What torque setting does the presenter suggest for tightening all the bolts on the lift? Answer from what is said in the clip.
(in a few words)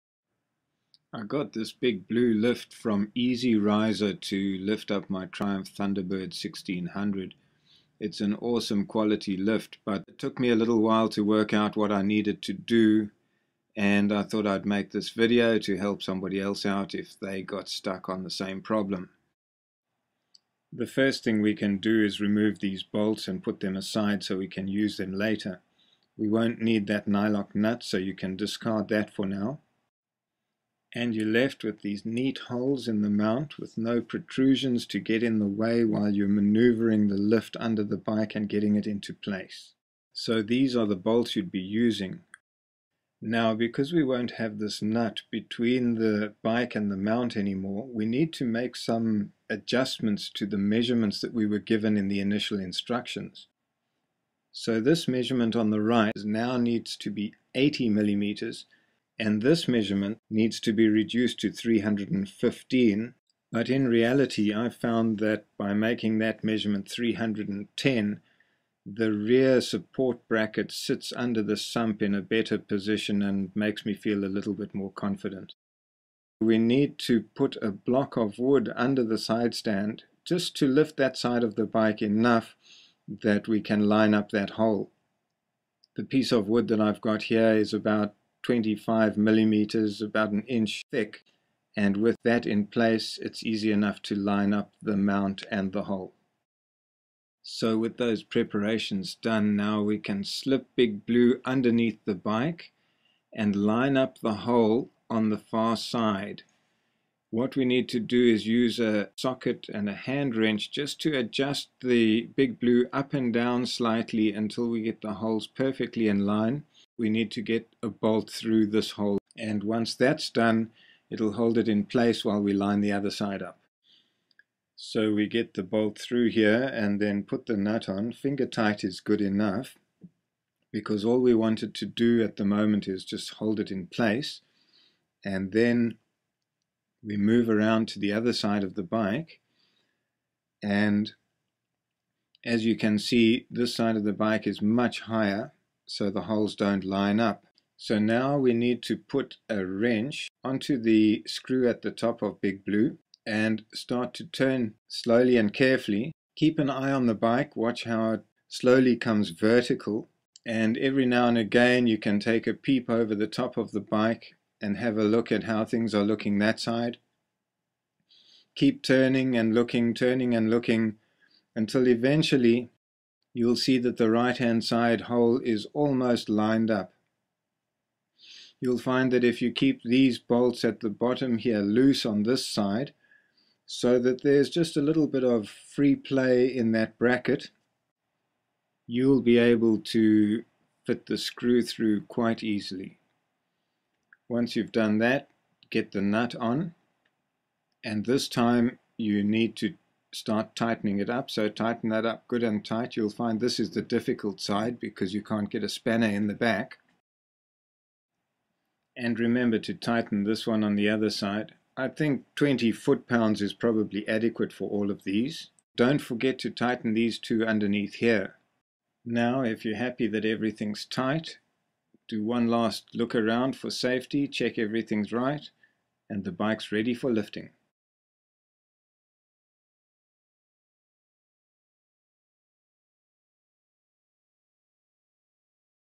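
20 foot-pounds.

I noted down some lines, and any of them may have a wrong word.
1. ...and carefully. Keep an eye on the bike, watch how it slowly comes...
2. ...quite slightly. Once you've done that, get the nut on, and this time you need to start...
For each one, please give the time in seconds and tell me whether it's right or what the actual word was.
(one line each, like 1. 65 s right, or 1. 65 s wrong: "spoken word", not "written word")
1. 155 s right
2. 192 s wrong: "easily", not "slightly".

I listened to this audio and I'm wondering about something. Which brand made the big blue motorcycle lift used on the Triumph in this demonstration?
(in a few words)
EazyRizer.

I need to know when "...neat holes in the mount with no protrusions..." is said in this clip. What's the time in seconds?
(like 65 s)
32 s.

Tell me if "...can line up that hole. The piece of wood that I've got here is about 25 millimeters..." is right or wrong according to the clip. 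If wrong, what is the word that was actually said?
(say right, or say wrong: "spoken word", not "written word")
right.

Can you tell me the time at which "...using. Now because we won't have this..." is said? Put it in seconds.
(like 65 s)
41 s.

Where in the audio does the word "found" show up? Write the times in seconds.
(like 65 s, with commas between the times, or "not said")
64 s.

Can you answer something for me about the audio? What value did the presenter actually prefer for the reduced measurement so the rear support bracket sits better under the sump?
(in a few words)
310.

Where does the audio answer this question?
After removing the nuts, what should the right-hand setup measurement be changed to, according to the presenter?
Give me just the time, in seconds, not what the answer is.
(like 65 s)
57 s.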